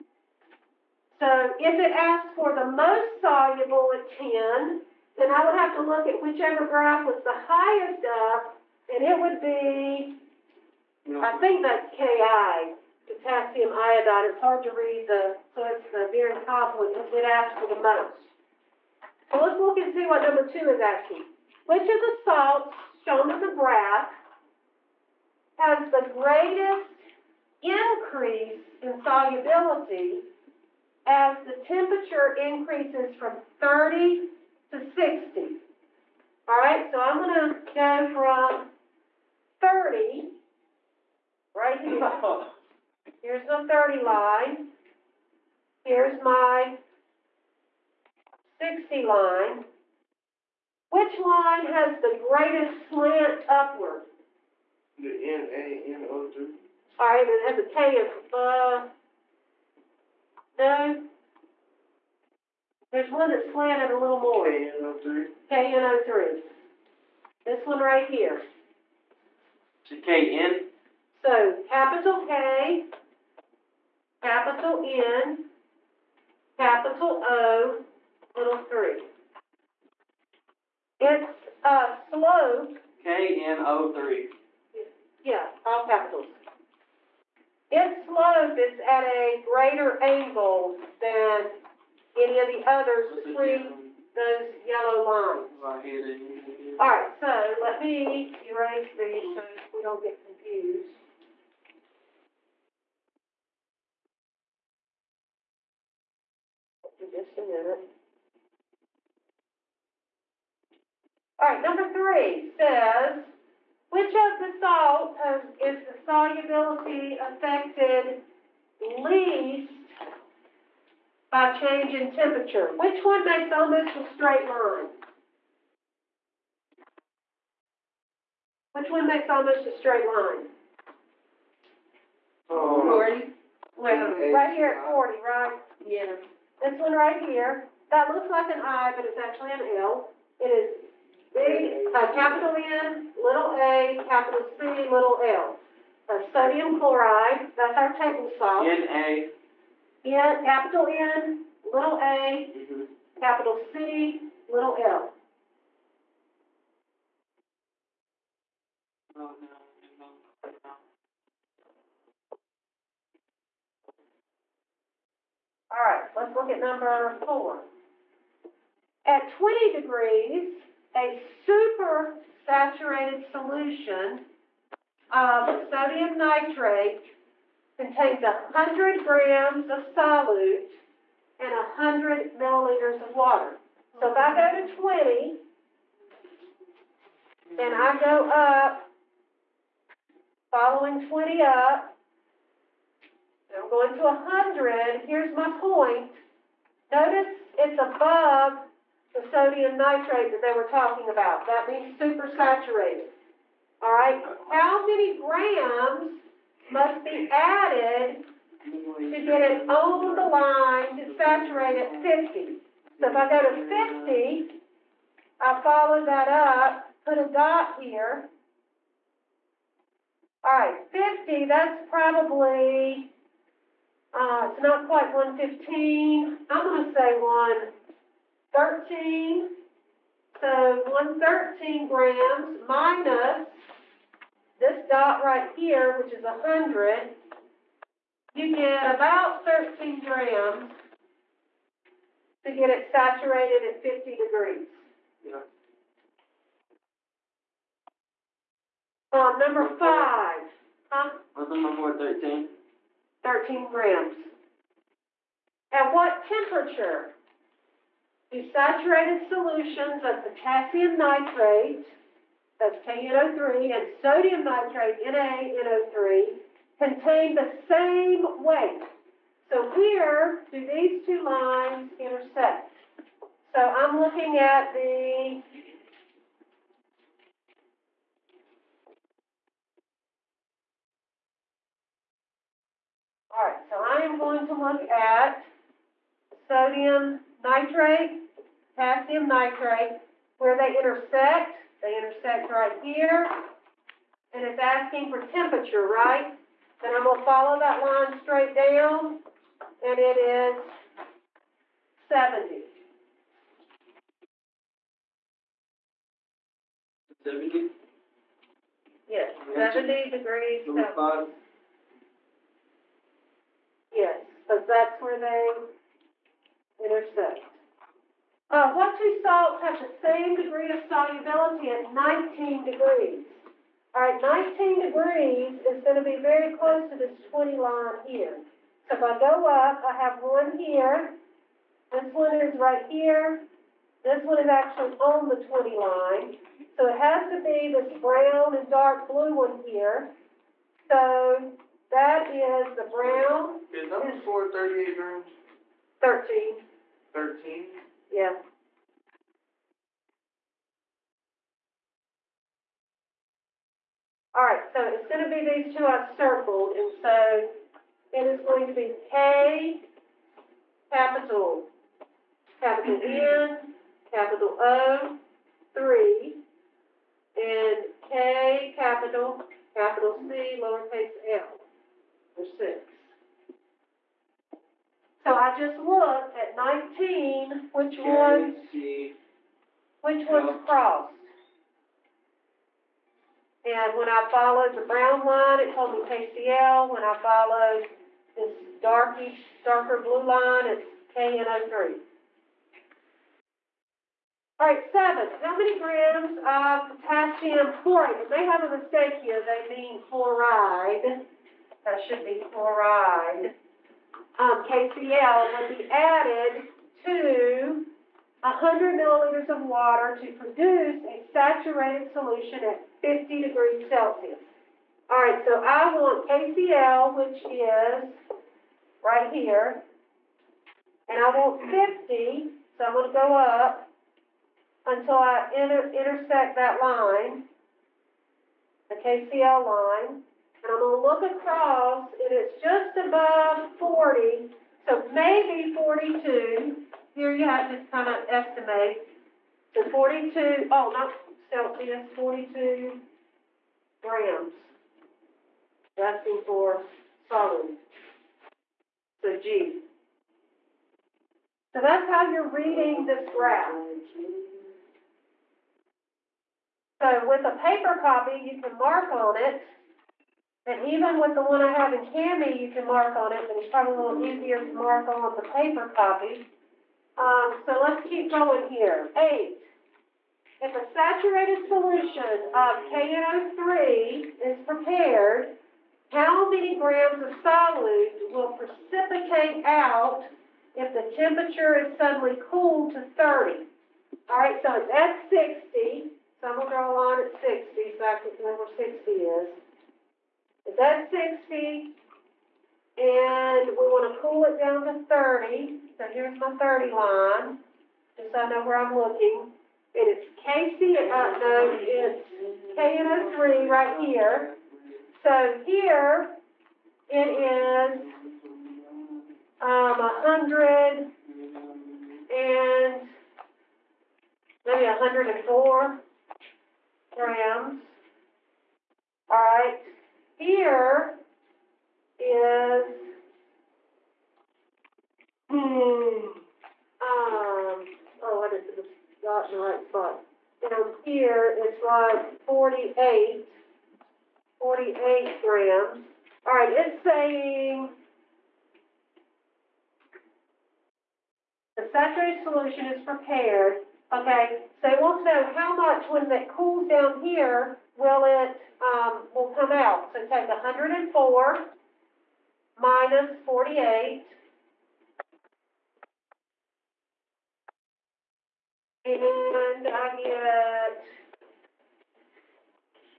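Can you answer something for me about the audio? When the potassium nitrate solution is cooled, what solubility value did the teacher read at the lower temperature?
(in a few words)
48 grams.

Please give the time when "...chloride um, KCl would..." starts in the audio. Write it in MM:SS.
06:42.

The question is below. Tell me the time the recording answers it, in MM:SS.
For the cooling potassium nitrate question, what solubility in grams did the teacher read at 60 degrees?
08:34.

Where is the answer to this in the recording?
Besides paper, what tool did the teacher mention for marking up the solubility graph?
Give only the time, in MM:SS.
07:42.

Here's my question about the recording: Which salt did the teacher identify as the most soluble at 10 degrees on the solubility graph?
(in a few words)
potassium iodide.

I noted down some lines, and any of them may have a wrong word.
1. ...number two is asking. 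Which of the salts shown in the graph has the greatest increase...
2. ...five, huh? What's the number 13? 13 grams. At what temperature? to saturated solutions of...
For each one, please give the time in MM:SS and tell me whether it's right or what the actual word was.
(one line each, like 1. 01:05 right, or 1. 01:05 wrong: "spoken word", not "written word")
1. 00:20 right
2. 04:09 right.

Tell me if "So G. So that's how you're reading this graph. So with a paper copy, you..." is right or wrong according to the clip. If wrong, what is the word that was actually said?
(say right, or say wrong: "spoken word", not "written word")
right.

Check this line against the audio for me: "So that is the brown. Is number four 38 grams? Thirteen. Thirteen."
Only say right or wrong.
right.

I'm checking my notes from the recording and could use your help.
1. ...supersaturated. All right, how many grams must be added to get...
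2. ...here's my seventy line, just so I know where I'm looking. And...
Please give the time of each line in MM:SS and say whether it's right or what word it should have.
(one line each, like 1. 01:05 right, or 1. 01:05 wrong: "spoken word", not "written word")
1. 03:21 right
2. 08:16 wrong: "thirty", not "seventy".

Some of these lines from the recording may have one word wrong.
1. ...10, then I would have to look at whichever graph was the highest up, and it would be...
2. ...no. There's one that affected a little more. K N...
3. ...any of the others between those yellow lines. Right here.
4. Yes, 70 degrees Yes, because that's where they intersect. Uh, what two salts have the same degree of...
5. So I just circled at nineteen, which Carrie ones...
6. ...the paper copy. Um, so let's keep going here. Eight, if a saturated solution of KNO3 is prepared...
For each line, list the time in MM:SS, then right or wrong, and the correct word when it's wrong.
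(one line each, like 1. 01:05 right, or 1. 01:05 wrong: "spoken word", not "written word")
1. 00:04 right
2. 01:00 wrong: "slanted", not "affected"
3. 01:32 right
4. 05:09 right
5. 06:15 wrong: "looked", not "circled"
6. 07:45 right.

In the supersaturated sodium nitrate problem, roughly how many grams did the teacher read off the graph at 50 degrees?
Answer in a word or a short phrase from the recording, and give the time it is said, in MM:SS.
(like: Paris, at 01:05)
113, at 03:50.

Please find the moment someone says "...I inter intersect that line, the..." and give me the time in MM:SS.
07:05.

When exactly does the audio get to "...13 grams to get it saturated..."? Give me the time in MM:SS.
03:59.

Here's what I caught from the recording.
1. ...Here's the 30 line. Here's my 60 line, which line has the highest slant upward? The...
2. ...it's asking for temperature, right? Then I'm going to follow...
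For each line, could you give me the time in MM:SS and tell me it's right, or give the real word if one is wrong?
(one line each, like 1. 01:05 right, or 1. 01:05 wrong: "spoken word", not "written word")
1. 00:43 wrong: "greatest", not "highest"
2. 04:54 right.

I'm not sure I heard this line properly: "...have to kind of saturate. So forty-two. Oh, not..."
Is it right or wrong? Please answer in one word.
wrong.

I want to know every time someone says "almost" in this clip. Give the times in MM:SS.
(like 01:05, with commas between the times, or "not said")
02:03, 02:09.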